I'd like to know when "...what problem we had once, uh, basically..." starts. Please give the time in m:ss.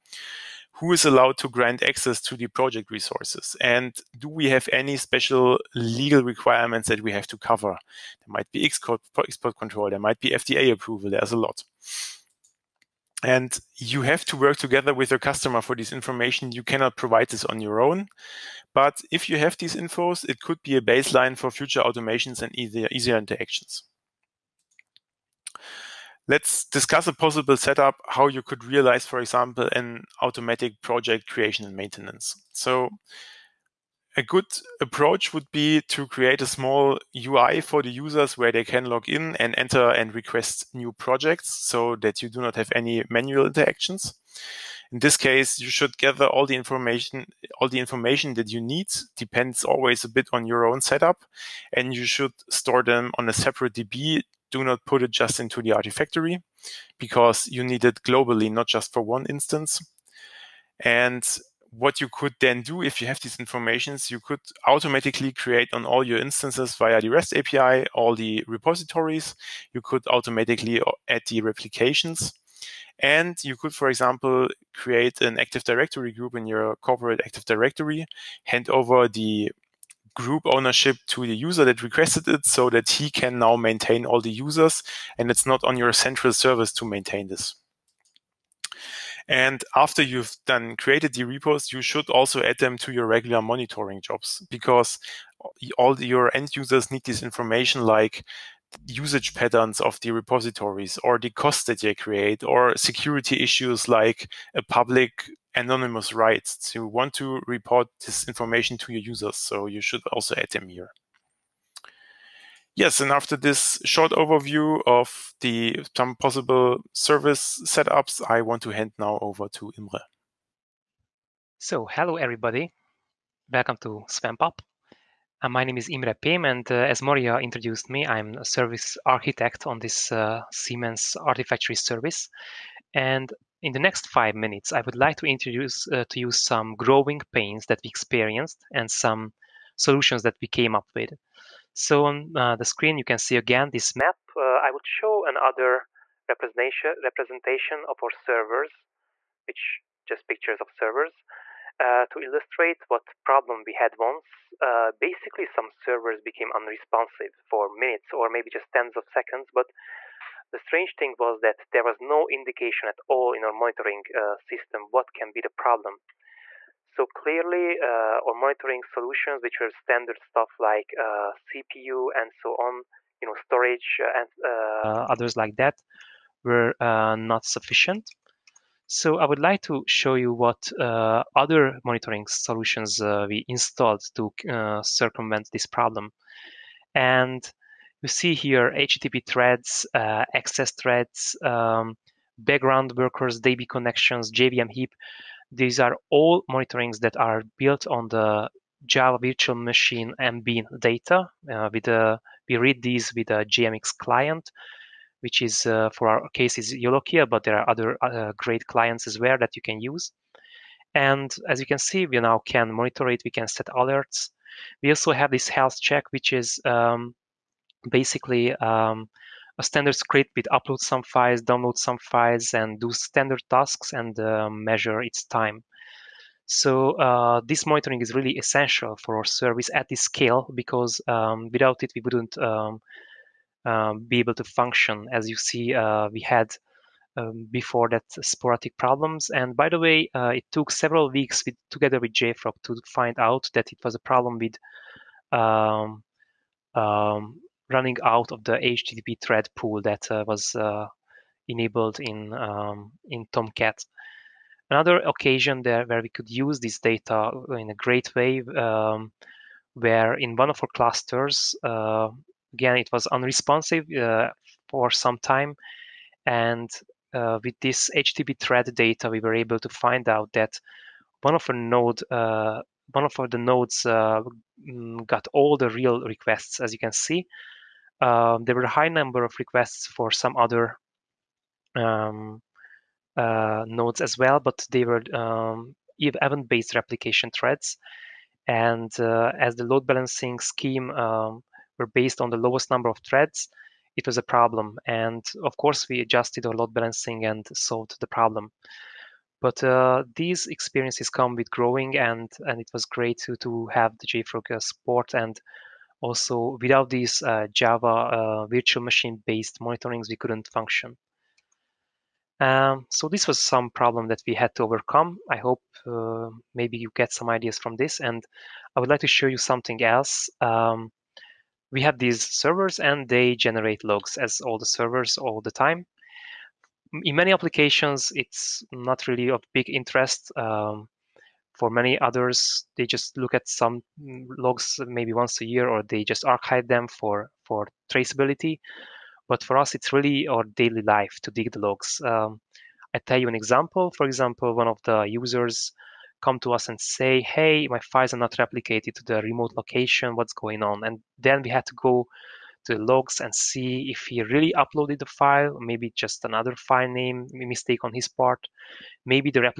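2:32.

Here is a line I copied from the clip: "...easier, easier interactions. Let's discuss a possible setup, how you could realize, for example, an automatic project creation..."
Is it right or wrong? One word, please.
right.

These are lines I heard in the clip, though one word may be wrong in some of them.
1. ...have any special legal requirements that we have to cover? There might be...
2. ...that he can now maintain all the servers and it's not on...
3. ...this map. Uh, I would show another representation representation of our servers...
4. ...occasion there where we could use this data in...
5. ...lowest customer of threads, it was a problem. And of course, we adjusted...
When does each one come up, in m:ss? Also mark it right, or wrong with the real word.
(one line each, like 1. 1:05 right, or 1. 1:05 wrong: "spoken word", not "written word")
1. 0:04 right
2. 1:22 wrong: "users", not "servers"
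3. 2:23 right
4. 4:14 right
5. 4:52 wrong: "number", not "customer".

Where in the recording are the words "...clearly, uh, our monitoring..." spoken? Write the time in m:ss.
2:47.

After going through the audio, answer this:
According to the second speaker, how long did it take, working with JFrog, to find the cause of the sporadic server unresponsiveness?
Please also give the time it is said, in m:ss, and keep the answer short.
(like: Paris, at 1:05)
Several weeks, at 4:00.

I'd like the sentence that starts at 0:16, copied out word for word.
You cannot provide this on your own.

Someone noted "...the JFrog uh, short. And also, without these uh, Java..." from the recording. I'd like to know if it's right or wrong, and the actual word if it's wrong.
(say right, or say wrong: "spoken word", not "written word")
wrong: "support", not "short".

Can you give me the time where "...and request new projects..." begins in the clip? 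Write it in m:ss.
0:39.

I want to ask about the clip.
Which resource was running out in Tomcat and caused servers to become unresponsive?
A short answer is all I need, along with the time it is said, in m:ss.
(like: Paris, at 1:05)
HTTP thread pool, at 4:08.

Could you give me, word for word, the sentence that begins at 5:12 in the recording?
Um, so this was some problem that we had to overcome.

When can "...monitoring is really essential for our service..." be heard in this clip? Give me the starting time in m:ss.
3:47.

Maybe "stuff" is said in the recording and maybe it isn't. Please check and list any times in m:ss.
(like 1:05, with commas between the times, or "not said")
2:50.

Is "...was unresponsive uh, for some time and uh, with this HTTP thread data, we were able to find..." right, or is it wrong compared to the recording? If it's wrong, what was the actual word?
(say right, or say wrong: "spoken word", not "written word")
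right.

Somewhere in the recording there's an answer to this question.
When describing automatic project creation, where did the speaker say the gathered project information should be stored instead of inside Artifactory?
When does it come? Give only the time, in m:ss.
0:53.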